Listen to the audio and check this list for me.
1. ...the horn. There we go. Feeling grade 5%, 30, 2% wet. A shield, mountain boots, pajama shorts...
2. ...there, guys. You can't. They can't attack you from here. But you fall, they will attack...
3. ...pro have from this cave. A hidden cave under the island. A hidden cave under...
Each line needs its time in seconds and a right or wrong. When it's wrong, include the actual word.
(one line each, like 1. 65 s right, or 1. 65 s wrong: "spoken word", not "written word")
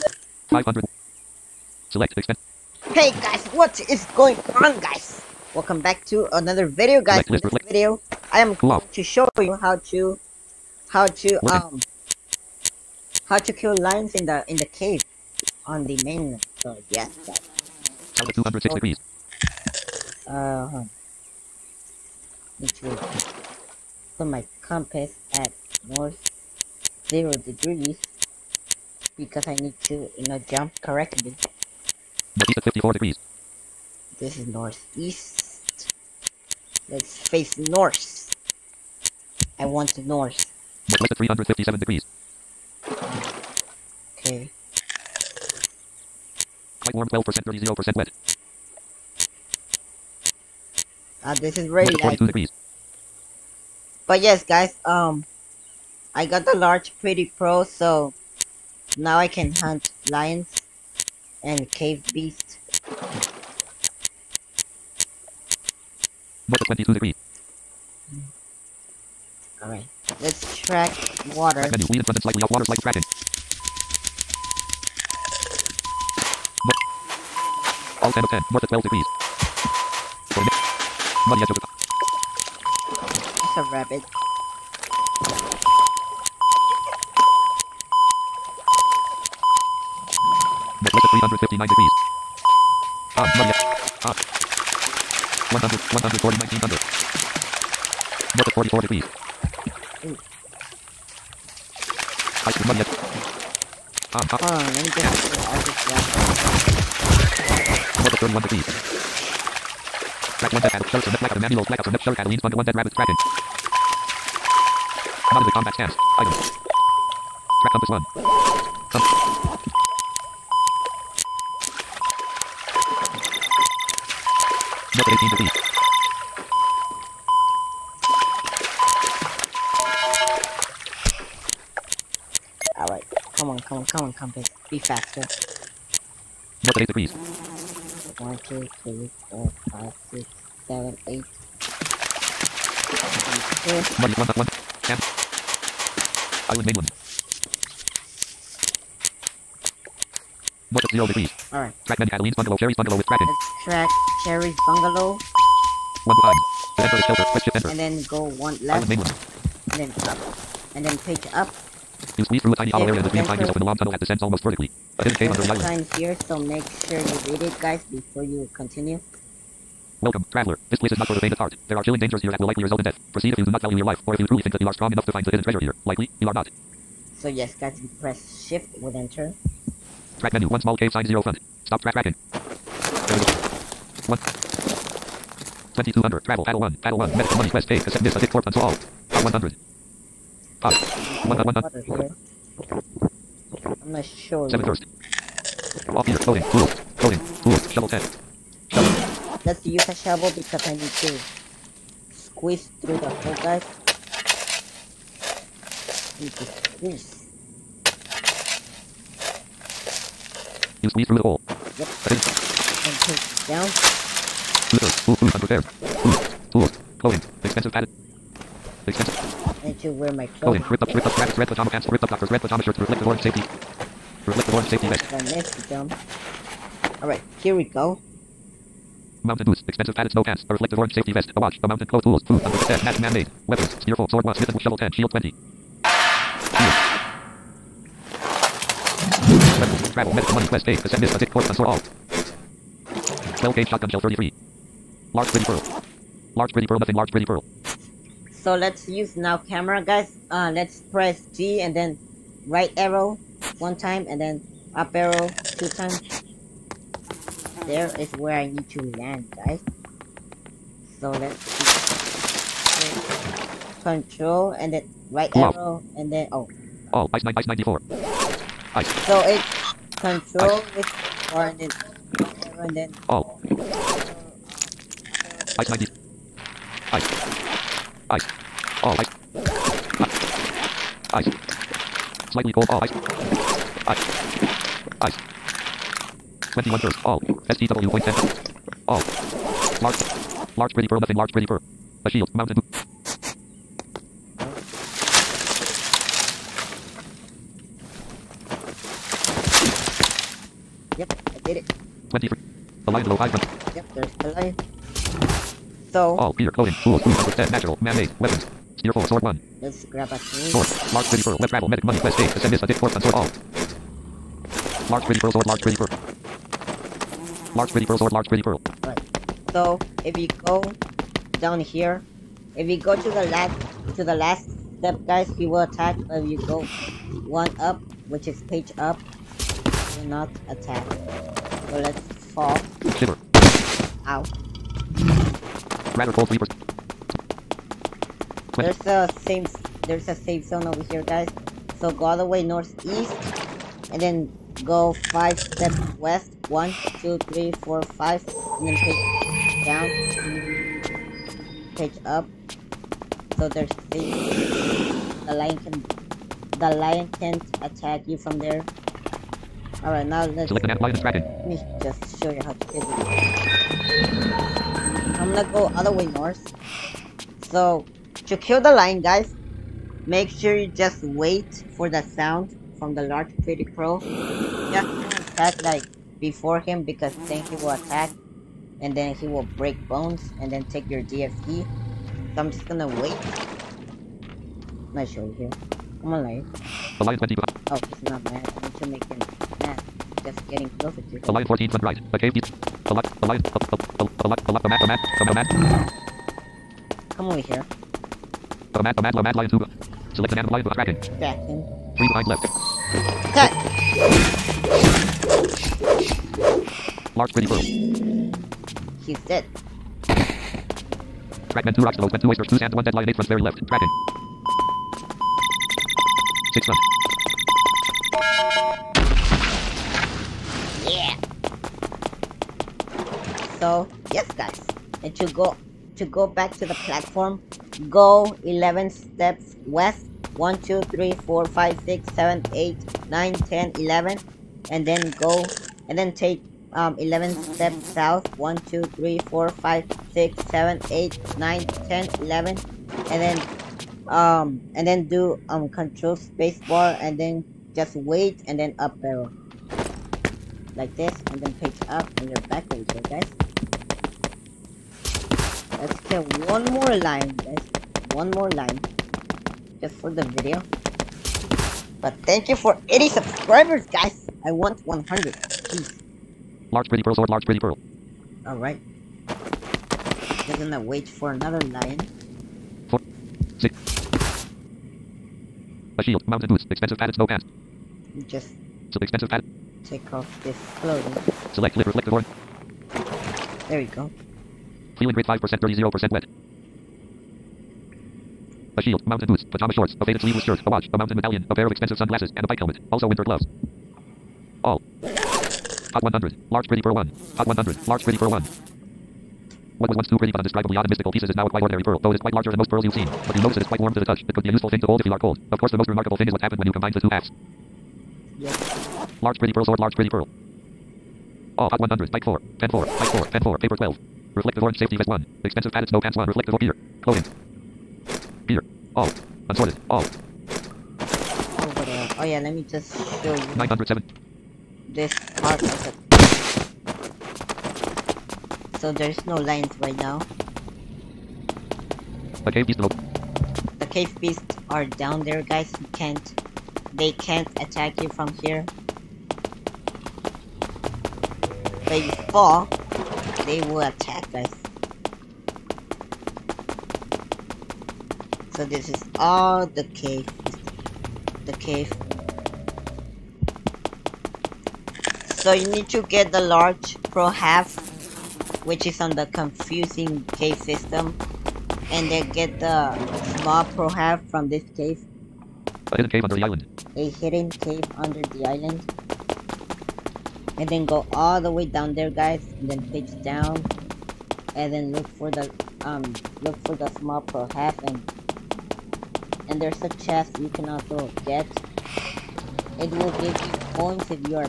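1. 482 s wrong: "0", not "2"
2. 535 s right
3. 563 s right.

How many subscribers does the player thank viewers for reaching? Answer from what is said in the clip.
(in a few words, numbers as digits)
80.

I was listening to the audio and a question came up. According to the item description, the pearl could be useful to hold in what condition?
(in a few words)
if you are cold.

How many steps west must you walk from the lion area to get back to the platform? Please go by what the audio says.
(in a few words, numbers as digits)
11.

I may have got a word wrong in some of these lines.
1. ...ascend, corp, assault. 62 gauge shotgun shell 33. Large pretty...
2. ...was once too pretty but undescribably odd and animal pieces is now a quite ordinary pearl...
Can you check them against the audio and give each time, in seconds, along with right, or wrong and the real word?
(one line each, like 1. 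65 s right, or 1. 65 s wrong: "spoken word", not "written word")
1. 241 s wrong: "12", not "62"
2. 499 s wrong: "mystical", not "animal".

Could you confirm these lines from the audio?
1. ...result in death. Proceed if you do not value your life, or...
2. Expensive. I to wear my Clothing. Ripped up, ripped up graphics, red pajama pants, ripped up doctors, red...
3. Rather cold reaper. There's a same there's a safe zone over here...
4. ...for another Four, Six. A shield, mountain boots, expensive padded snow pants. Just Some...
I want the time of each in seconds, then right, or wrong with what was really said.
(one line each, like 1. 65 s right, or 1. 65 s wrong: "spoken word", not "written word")
1. 172 s right
2. 218 s right
3. 335 s right
4. 471 s right.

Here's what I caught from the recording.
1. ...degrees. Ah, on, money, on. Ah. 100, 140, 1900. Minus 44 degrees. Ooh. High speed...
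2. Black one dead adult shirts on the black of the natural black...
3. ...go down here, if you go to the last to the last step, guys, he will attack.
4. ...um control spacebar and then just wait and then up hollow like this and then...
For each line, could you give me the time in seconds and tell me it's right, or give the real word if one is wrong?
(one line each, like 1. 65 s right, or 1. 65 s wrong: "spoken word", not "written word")
1. 91 s right
2. 110 s wrong: "manual", not "natural"
3. 320 s right
4. 445 s wrong: "arrow", not "hollow".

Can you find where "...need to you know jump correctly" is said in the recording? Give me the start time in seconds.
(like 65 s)
29 s.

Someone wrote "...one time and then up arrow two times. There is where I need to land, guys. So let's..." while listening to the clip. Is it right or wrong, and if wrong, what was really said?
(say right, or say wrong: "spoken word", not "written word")
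right.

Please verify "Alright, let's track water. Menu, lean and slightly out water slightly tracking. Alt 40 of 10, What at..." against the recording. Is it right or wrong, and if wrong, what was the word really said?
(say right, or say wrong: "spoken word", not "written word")
wrong: "10", not "40".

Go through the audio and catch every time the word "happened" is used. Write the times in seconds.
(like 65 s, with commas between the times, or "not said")
506 s.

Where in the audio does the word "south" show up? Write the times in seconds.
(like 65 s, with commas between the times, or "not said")
437 s.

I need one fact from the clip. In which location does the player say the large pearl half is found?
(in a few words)
confusing cave system.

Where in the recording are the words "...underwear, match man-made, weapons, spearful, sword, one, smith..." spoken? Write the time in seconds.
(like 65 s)
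232 s.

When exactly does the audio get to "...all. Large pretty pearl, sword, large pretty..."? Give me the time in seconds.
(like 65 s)
313 s.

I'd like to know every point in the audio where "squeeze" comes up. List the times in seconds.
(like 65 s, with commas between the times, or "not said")
162 s, 202 s, 206 s, 210 s.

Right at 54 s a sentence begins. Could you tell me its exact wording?
But yes, guys, um, I got the large pretty pro, so now I can hunt lions and cave beast.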